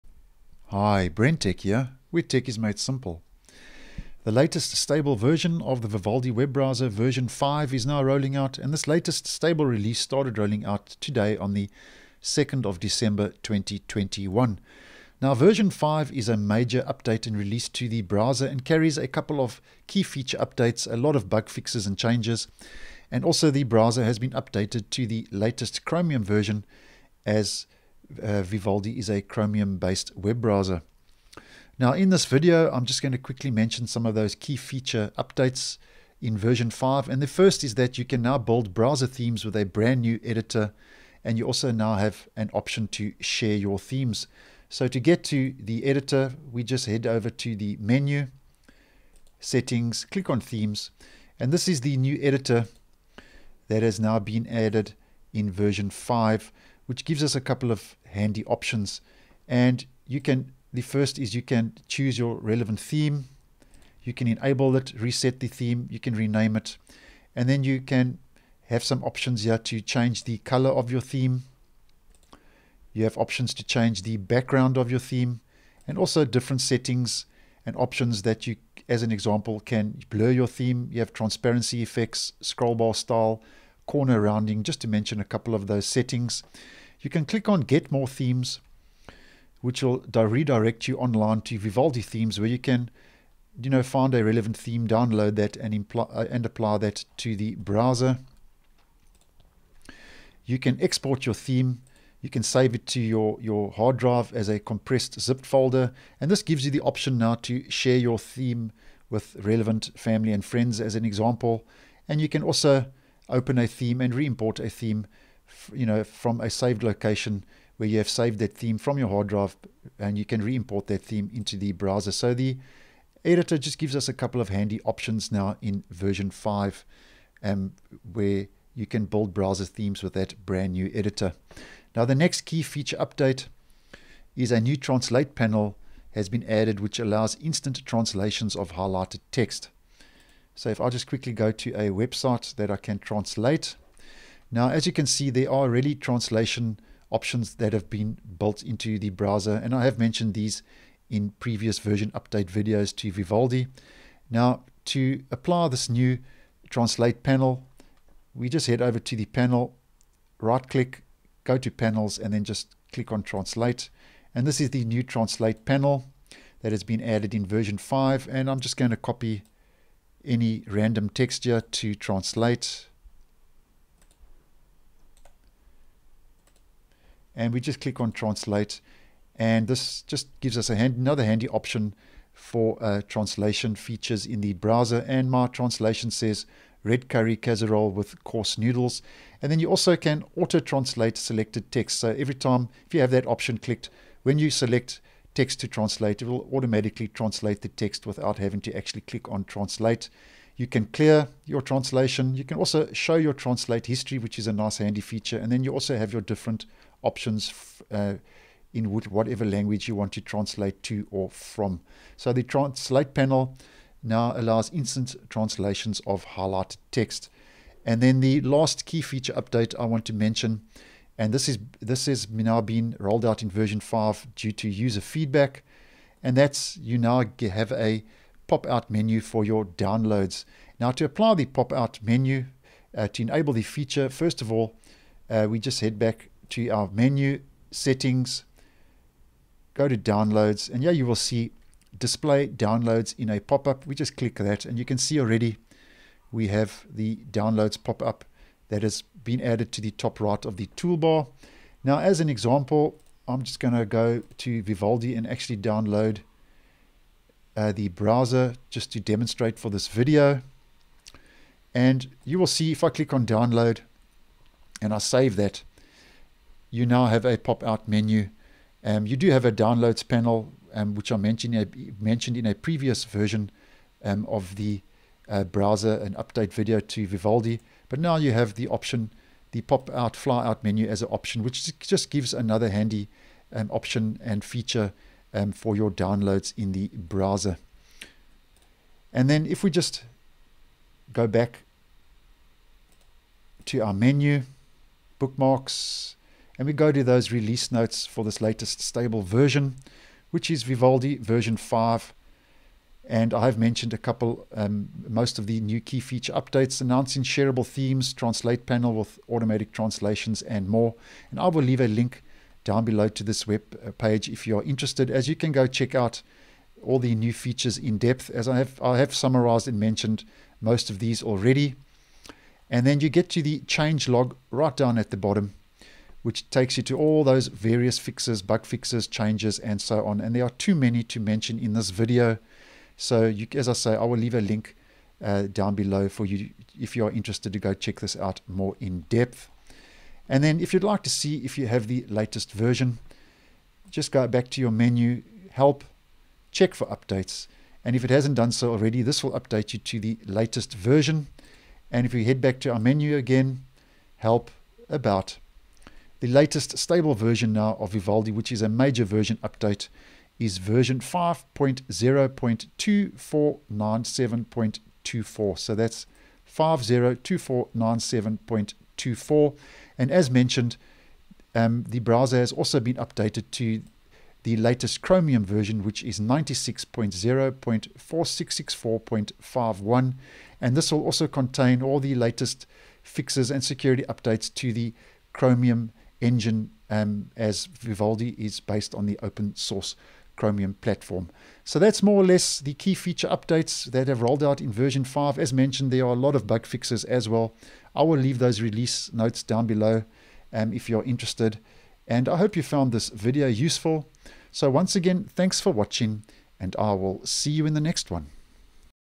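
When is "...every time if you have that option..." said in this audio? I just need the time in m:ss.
3:12.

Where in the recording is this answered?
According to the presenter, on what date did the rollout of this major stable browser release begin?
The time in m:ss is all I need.
0:12.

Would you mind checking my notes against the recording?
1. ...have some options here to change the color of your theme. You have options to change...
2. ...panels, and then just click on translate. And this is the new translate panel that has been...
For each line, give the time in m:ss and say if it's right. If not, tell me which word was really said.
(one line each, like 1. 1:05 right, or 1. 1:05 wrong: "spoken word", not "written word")
1. 1:08 right
2. 2:41 right.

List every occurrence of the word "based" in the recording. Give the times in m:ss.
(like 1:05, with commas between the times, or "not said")
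0:29, 6:28.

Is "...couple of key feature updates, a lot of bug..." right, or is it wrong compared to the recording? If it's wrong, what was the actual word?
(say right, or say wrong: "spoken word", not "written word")
right.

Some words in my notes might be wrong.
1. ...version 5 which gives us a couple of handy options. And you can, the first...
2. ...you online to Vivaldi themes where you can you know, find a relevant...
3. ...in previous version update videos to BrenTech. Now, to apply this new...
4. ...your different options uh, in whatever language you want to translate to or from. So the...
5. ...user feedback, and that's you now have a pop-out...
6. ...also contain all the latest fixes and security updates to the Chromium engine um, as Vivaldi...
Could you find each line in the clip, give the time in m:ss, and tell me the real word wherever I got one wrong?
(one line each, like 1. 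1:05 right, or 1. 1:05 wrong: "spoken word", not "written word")
1. 0:55 right
2. 1:30 right
3. 2:31 wrong: "Vivaldi", not "BrenTech"
4. 3:26 right
5. 3:44 right
6. 6:21 right.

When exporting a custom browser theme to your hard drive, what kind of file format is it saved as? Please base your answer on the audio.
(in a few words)
compressed zipped folder.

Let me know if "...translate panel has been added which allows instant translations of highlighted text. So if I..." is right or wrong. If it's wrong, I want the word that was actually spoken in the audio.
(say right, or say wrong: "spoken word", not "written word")
right.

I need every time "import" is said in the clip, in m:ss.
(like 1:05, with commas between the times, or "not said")
1:54, 2:00.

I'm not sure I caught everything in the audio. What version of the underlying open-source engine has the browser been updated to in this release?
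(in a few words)
96.0.4664.51.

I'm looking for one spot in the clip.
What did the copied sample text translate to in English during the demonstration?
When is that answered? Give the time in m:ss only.
3:06.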